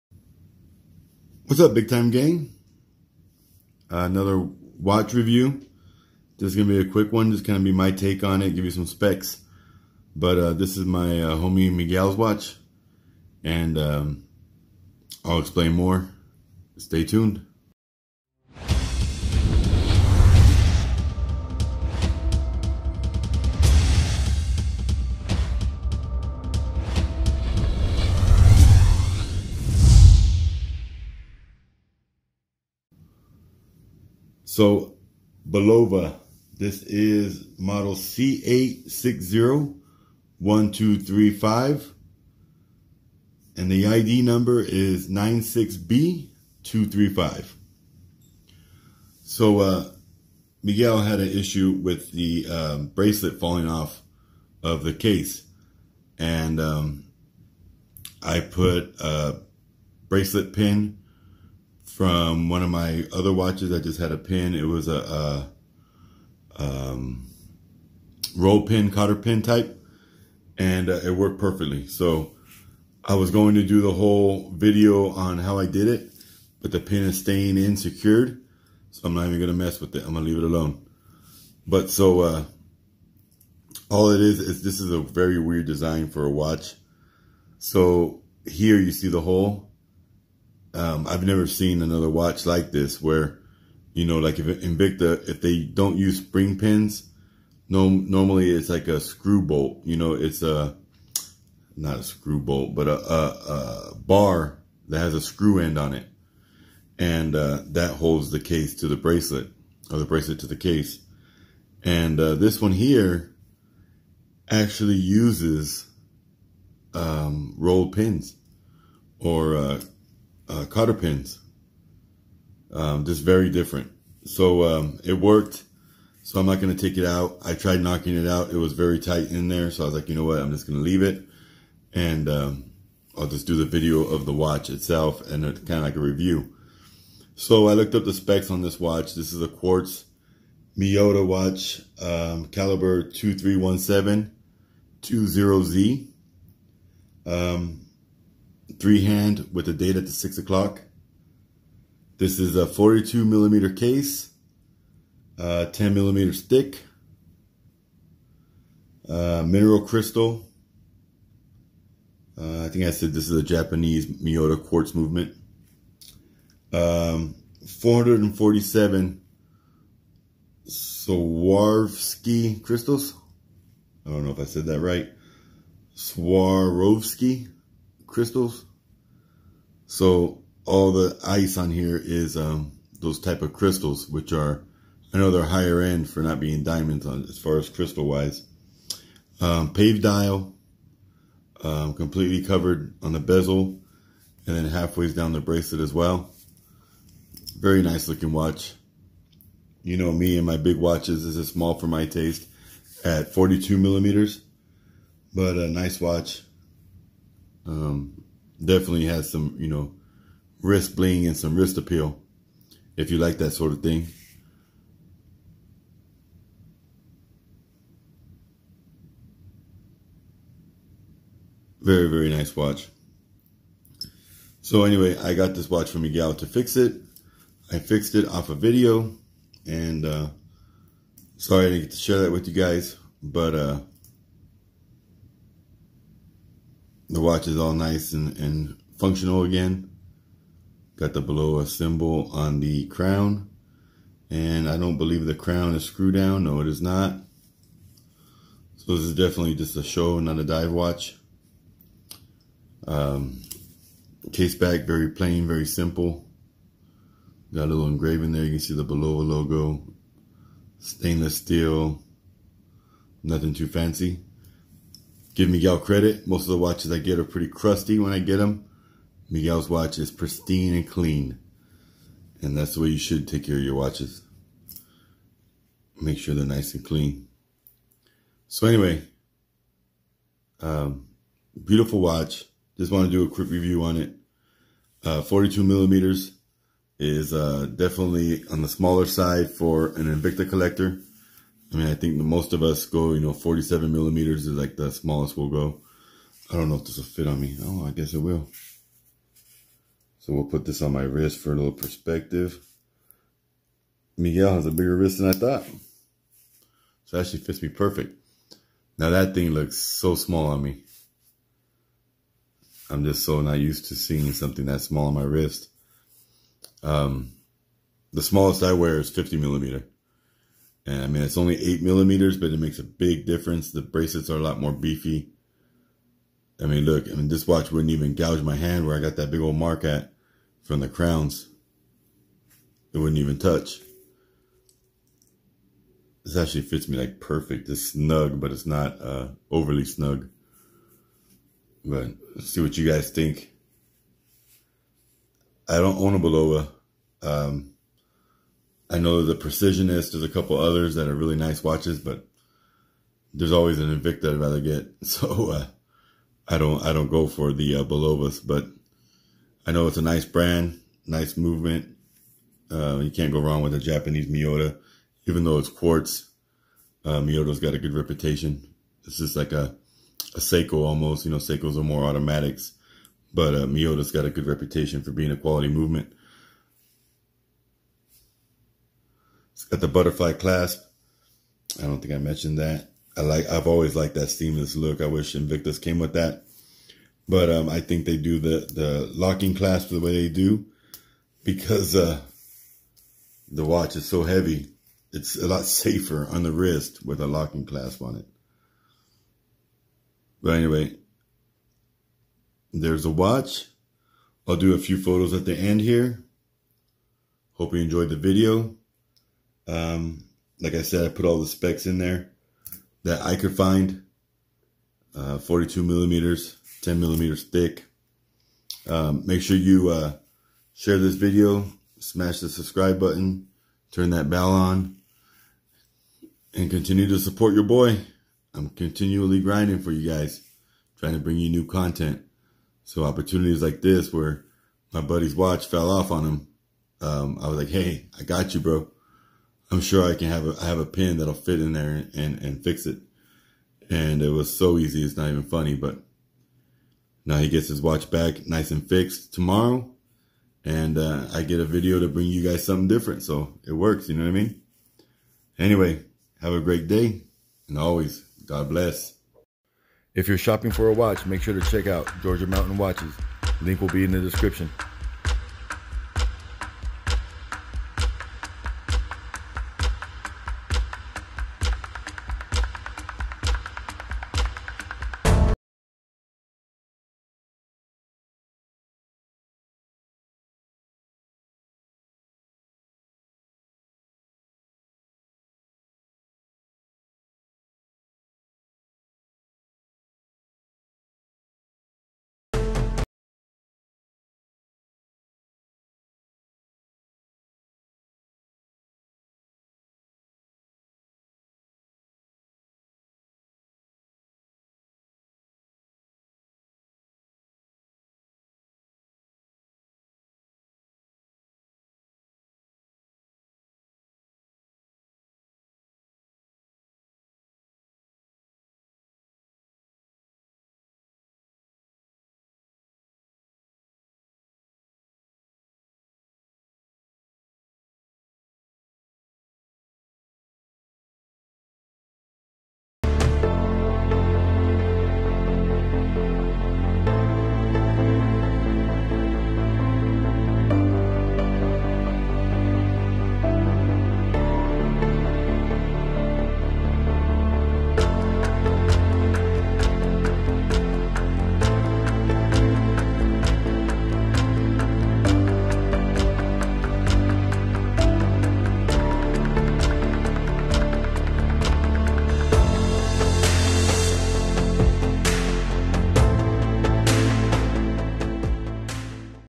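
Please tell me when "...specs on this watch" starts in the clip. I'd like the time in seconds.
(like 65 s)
138 s.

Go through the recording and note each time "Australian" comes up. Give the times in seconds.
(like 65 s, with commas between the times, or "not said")
not said.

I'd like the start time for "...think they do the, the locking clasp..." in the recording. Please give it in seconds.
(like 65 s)
387 s.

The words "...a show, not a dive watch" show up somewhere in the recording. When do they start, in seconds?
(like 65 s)
249 s.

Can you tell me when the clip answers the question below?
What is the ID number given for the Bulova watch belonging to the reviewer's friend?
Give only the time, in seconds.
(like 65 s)
45 s.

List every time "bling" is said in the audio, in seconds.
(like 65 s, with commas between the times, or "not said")
210 s.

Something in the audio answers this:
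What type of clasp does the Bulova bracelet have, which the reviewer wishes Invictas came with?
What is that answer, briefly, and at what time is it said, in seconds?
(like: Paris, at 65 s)
Butterfly clasp, at 379 s.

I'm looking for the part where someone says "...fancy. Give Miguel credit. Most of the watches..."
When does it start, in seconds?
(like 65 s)
263 s.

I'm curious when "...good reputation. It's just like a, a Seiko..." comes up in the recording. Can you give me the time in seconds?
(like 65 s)
367 s.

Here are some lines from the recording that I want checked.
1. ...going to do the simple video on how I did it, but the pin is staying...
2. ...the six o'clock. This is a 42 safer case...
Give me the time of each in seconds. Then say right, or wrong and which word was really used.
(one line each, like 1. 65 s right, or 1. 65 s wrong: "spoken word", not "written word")
1. 73 s wrong: "whole", not "simple"
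2. 150 s wrong: "millimeter", not "safer".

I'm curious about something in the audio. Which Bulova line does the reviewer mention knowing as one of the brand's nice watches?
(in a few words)
Precisionist.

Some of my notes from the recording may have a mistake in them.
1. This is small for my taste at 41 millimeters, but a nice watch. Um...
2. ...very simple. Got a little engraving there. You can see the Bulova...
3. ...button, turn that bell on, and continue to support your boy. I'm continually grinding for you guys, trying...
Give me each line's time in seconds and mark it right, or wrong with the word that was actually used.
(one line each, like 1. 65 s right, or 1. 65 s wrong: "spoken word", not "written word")
1. 201 s wrong: "42", not "41"
2. 255 s right
3. 422 s right.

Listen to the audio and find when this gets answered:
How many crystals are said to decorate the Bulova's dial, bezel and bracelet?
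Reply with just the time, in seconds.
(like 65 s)
167 s.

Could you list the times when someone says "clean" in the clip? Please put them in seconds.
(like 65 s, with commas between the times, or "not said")
270 s, 276 s.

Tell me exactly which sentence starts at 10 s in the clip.
But uh, this is my uh, homie Miguel's watch, and um, I'll explain more.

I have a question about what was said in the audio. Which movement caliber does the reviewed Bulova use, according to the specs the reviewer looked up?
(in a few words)
2317 20Z.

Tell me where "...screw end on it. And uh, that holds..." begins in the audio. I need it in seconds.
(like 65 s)
105 s.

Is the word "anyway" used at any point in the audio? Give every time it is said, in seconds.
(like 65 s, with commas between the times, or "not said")
224 s, 278 s, 400 s, 455 s.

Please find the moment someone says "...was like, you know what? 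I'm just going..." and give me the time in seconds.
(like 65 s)
129 s.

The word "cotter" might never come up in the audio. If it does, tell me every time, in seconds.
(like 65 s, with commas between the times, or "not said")
68 s, 120 s.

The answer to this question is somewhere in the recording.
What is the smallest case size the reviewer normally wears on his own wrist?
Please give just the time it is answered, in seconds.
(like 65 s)
319 s.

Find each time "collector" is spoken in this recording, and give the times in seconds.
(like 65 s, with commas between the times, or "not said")
290 s.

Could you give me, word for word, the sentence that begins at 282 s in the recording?
Just want to do a quick review on it.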